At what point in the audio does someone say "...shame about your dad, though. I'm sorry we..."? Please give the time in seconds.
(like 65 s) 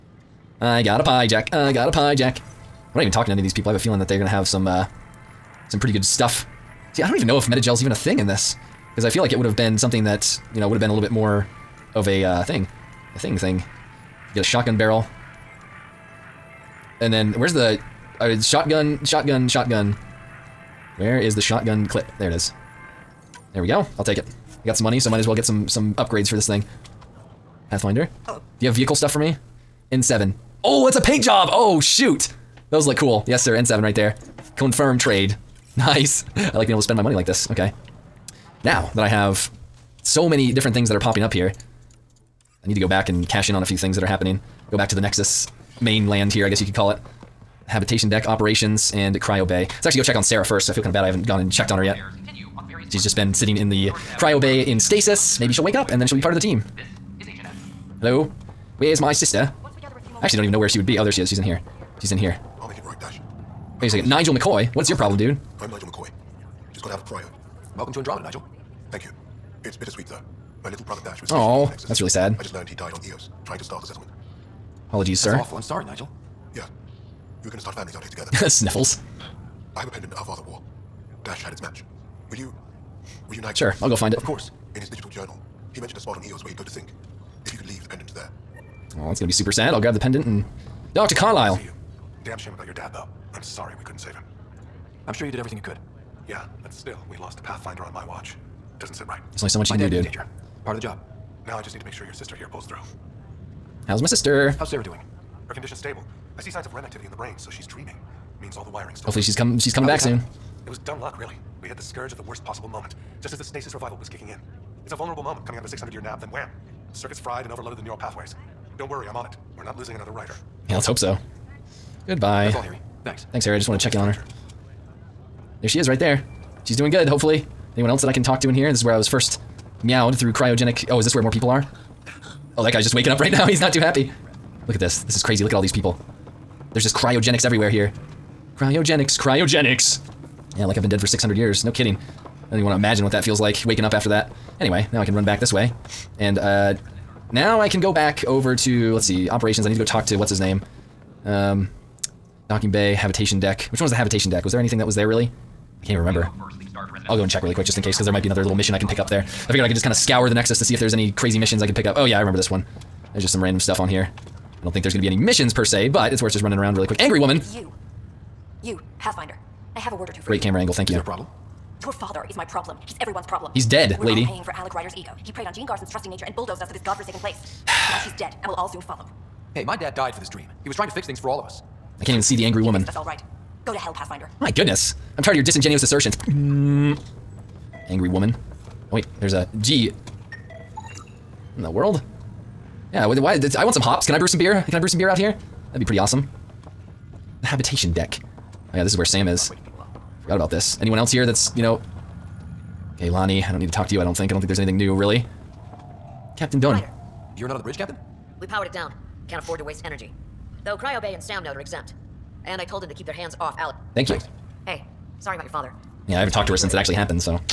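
92 s.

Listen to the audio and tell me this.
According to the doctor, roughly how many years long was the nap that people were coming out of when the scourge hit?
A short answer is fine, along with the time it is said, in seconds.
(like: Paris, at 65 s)
600, at 115 s.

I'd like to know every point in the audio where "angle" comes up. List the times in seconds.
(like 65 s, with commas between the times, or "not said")
170 s.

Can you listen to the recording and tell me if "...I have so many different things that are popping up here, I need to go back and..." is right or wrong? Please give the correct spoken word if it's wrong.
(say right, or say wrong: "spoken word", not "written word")
right.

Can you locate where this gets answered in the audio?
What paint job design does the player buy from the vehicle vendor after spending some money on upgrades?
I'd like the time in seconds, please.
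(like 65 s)
33 s.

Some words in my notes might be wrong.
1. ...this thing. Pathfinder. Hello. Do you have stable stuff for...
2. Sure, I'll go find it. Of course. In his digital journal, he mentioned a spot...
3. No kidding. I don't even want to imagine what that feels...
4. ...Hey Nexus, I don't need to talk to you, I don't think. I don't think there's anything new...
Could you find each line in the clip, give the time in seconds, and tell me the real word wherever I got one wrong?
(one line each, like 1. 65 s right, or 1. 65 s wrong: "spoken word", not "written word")
1. 26 s wrong: "vehicle", not "stable"
2. 83 s right
3. 141 s right
4. 203 s wrong: "Lonnie", not "Nexus".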